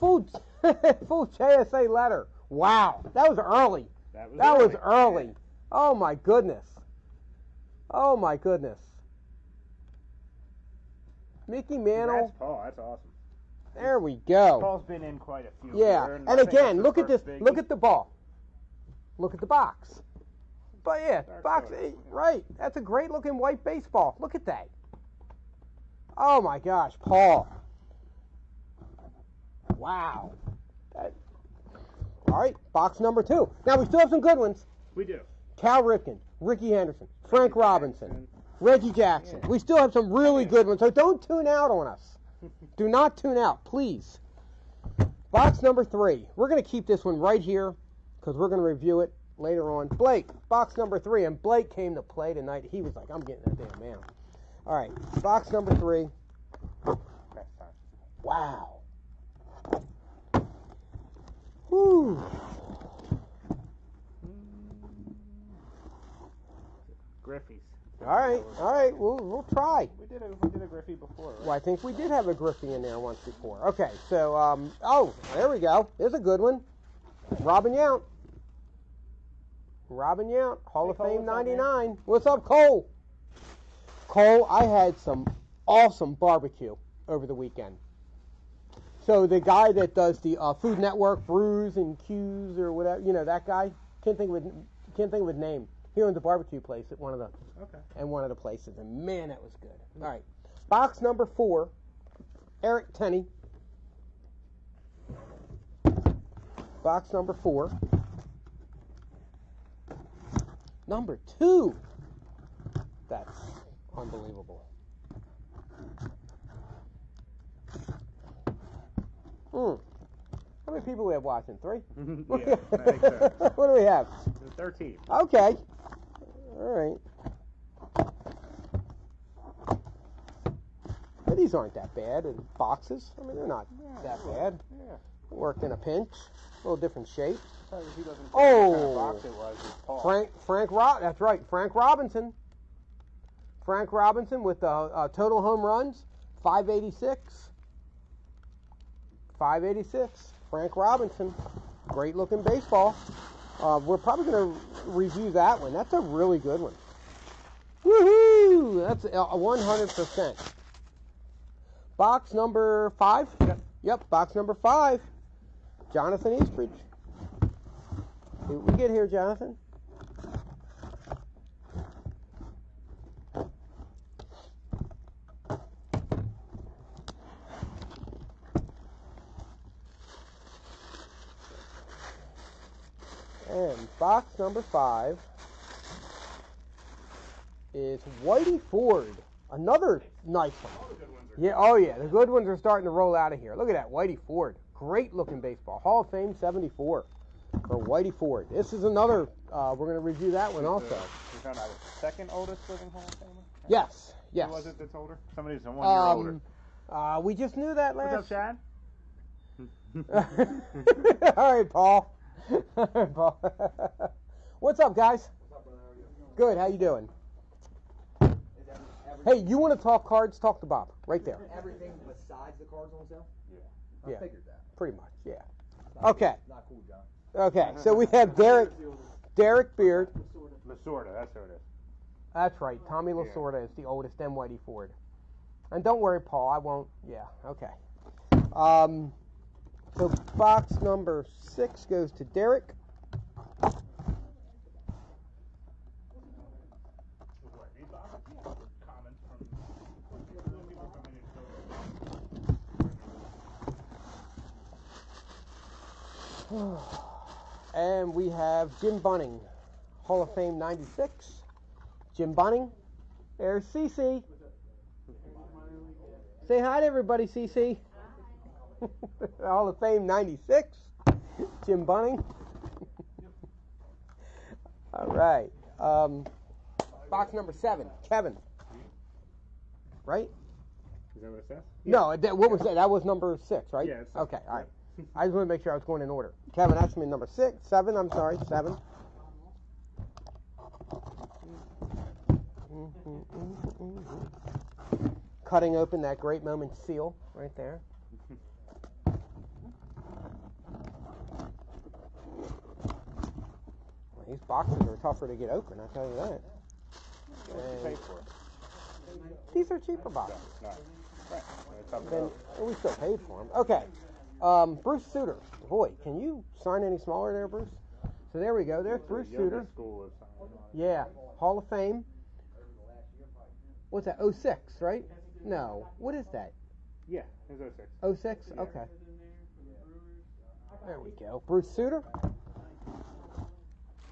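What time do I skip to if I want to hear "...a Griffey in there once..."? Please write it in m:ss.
1:12.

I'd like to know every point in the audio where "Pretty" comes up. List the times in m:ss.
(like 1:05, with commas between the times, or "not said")
3:44.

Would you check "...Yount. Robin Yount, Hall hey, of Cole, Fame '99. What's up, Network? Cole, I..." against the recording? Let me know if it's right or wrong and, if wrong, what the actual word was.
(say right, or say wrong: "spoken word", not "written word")
wrong: "Cole", not "Network".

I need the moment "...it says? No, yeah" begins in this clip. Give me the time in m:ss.
4:41.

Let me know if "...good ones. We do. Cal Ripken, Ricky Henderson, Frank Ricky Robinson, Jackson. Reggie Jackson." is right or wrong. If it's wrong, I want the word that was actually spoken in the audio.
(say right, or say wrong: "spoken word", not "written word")
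right.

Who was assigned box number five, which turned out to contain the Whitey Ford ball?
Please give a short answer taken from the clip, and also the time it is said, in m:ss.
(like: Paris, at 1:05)
Jonathan Eastridge, at 2:45.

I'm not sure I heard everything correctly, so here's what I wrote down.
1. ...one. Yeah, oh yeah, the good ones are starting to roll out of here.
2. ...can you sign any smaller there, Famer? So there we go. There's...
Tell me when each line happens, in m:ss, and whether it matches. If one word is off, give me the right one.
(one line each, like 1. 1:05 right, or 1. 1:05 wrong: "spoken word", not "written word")
1. 3:10 right
2. 5:16 wrong: "Bruce", not "Famer".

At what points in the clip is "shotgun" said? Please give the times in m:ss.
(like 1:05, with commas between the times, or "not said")
not said.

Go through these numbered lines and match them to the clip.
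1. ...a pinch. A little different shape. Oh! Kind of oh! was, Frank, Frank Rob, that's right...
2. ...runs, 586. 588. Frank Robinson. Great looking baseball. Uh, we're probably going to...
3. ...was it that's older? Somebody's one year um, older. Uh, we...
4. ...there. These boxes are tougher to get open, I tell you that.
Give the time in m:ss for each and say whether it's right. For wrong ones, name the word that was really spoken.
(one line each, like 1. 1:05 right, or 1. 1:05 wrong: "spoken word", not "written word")
1. 2:15 right
2. 2:25 wrong: "586", not "588"
3. 3:24 right
4. 4:57 right.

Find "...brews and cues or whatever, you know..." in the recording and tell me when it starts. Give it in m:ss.
1:31.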